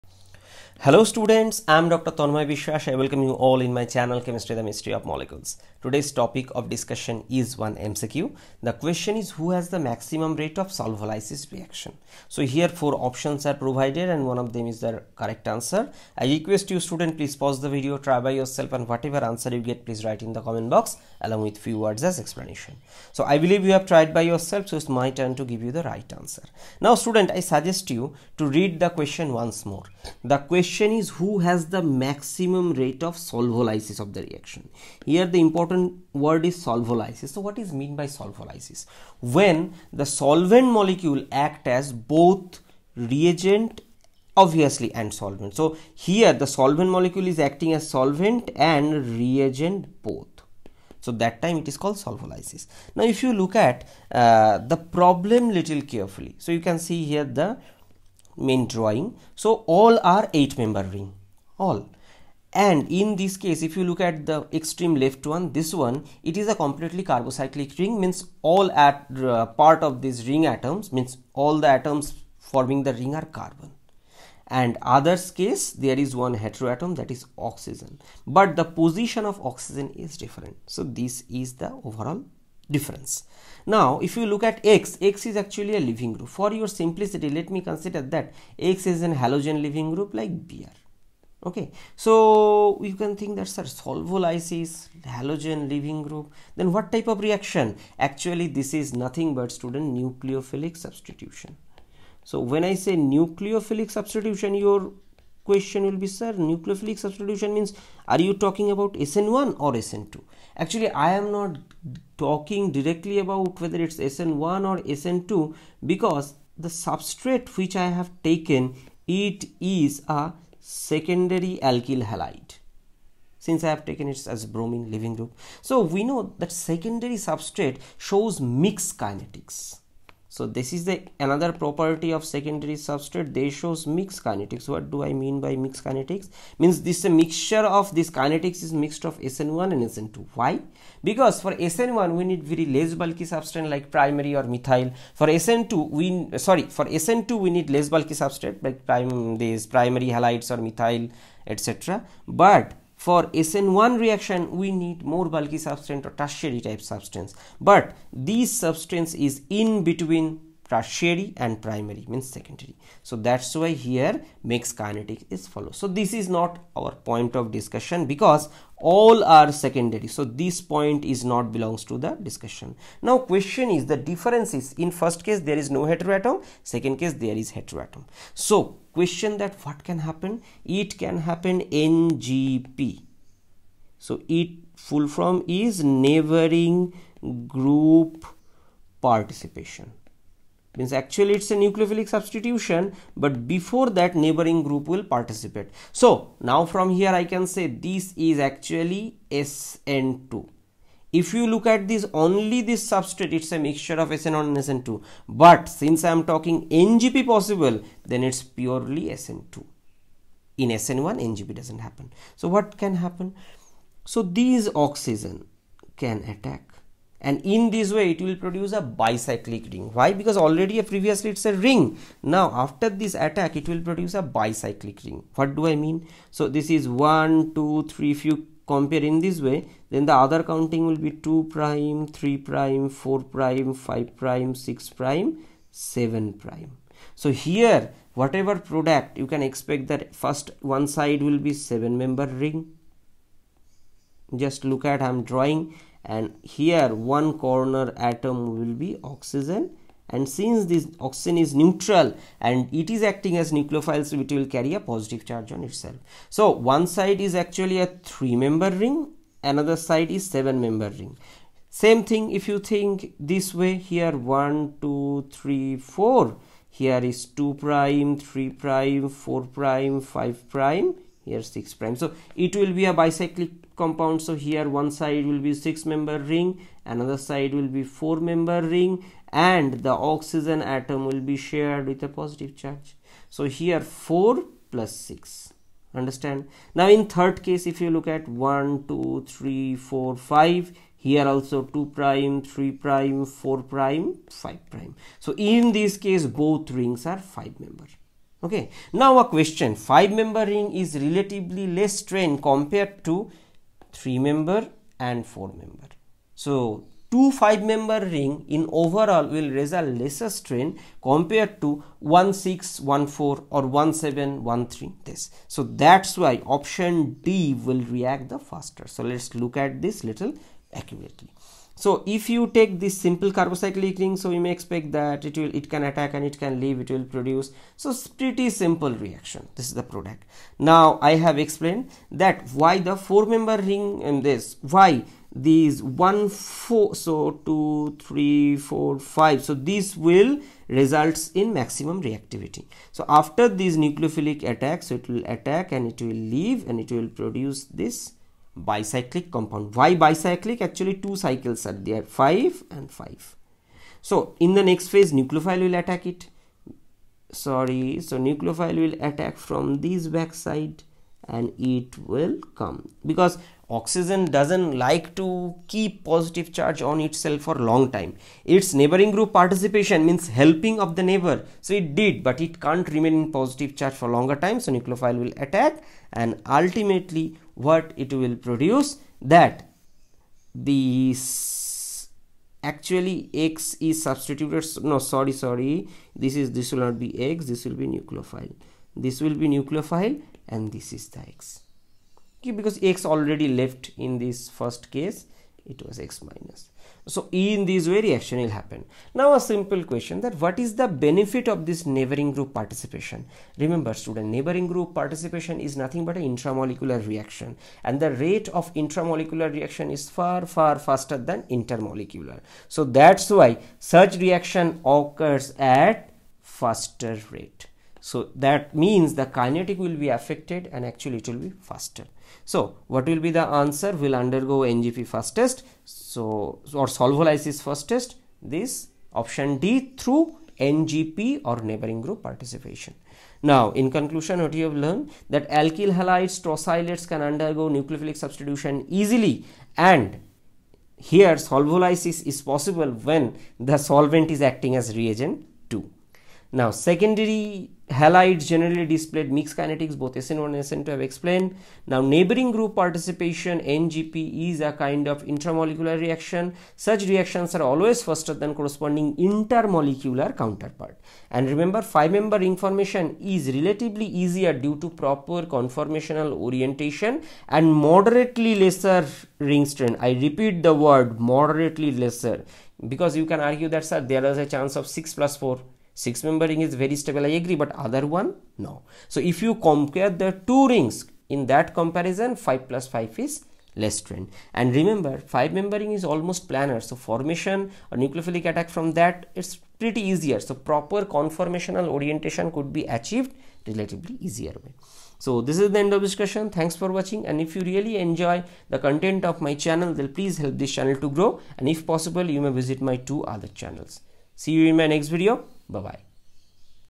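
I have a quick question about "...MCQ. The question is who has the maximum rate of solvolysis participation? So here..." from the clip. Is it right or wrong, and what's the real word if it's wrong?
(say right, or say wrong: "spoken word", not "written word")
wrong: "reaction", not "participation".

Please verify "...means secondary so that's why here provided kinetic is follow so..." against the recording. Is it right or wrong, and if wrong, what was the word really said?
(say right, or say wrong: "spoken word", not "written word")
wrong: "mixed", not "provided".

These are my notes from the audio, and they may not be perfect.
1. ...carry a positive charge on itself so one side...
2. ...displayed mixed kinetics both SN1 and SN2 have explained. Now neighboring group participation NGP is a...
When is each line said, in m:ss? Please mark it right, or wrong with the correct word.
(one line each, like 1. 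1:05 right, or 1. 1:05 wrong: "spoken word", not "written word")
1. 4:14 right
2. 7:28 right.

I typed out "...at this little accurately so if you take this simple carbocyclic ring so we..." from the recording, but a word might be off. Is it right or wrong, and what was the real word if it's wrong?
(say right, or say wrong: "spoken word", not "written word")
right.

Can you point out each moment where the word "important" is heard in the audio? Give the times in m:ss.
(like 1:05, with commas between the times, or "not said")
0:35.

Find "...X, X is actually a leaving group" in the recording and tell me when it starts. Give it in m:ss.
1:24.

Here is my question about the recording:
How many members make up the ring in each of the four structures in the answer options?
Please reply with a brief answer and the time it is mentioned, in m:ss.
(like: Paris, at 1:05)
8, at 1:00.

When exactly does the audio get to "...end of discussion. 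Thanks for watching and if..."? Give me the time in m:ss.
8:15.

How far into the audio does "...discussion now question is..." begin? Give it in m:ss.
2:52.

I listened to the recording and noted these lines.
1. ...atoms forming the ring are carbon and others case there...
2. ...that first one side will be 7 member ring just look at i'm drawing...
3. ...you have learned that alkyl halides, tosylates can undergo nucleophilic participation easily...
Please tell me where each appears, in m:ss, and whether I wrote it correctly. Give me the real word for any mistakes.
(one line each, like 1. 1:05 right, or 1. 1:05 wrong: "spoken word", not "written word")
1. 1:11 right
2. 3:59 right
3. 7:14 wrong: "substitution", not "participation".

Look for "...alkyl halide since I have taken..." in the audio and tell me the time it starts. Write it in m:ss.
2:01.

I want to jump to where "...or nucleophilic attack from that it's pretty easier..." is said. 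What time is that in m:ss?
8:07.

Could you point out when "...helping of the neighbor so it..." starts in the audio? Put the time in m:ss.
6:10.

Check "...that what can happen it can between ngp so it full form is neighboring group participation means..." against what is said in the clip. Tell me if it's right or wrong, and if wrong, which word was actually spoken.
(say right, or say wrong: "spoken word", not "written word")
wrong: "happen", not "between".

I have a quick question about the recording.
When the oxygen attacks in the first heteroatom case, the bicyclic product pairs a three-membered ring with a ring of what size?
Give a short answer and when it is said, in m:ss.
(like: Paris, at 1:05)
7, at 4:20.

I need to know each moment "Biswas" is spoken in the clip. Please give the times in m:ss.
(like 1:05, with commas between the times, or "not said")
0:02.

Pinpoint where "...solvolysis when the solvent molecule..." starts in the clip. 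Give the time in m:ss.
0:38.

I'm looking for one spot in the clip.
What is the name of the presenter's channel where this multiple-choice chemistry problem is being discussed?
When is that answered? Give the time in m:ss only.
0:04.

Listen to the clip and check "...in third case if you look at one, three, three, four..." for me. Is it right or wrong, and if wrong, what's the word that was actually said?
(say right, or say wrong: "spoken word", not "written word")
wrong: "two", not "three".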